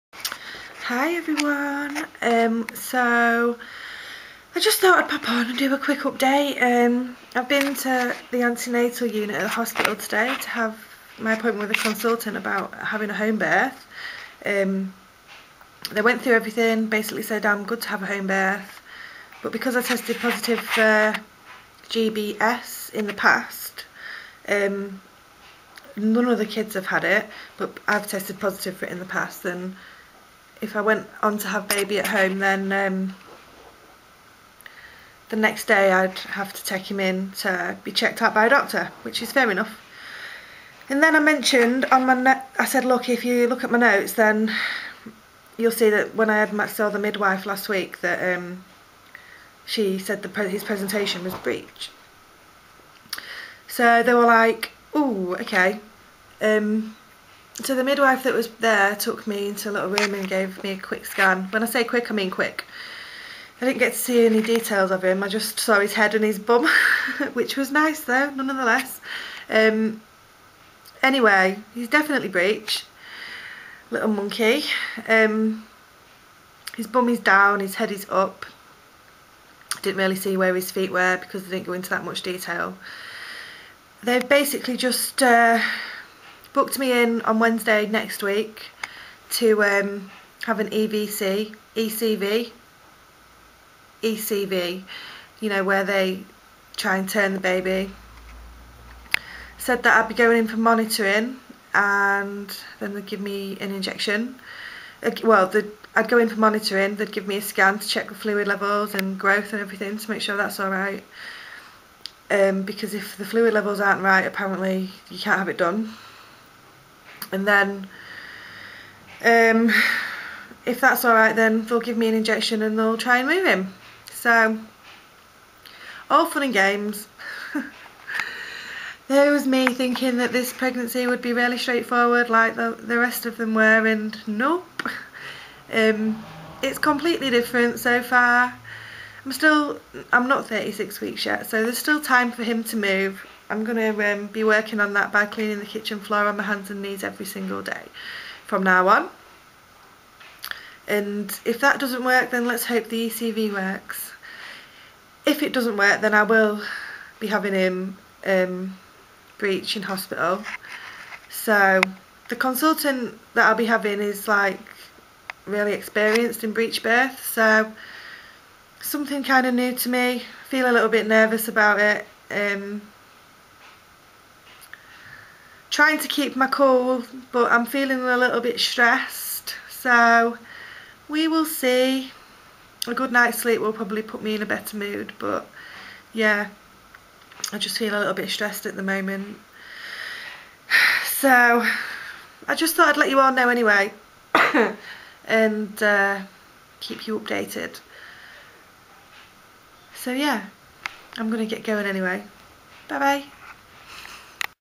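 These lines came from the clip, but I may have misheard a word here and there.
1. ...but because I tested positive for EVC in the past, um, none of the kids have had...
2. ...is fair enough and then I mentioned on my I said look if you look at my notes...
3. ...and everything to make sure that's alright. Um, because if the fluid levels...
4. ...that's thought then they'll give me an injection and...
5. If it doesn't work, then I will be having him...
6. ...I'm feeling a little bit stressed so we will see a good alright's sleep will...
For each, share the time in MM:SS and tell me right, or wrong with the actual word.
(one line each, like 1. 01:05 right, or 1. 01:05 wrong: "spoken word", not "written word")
1. 00:19 wrong: "GBS", not "EVC"
2. 00:39 right
3. 01:49 right
4. 02:00 wrong: "alright", not "thought"
5. 02:35 right
6. 02:57 wrong: "night", not "alright".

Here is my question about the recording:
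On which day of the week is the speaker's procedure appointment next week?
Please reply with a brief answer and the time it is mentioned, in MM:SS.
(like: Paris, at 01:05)
Wednesday, at 01:27.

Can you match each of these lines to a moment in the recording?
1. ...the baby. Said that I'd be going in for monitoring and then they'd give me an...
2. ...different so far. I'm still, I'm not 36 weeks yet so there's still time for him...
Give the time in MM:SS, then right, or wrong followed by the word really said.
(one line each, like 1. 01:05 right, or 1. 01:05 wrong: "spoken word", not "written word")
1. 01:37 right
2. 02:17 right.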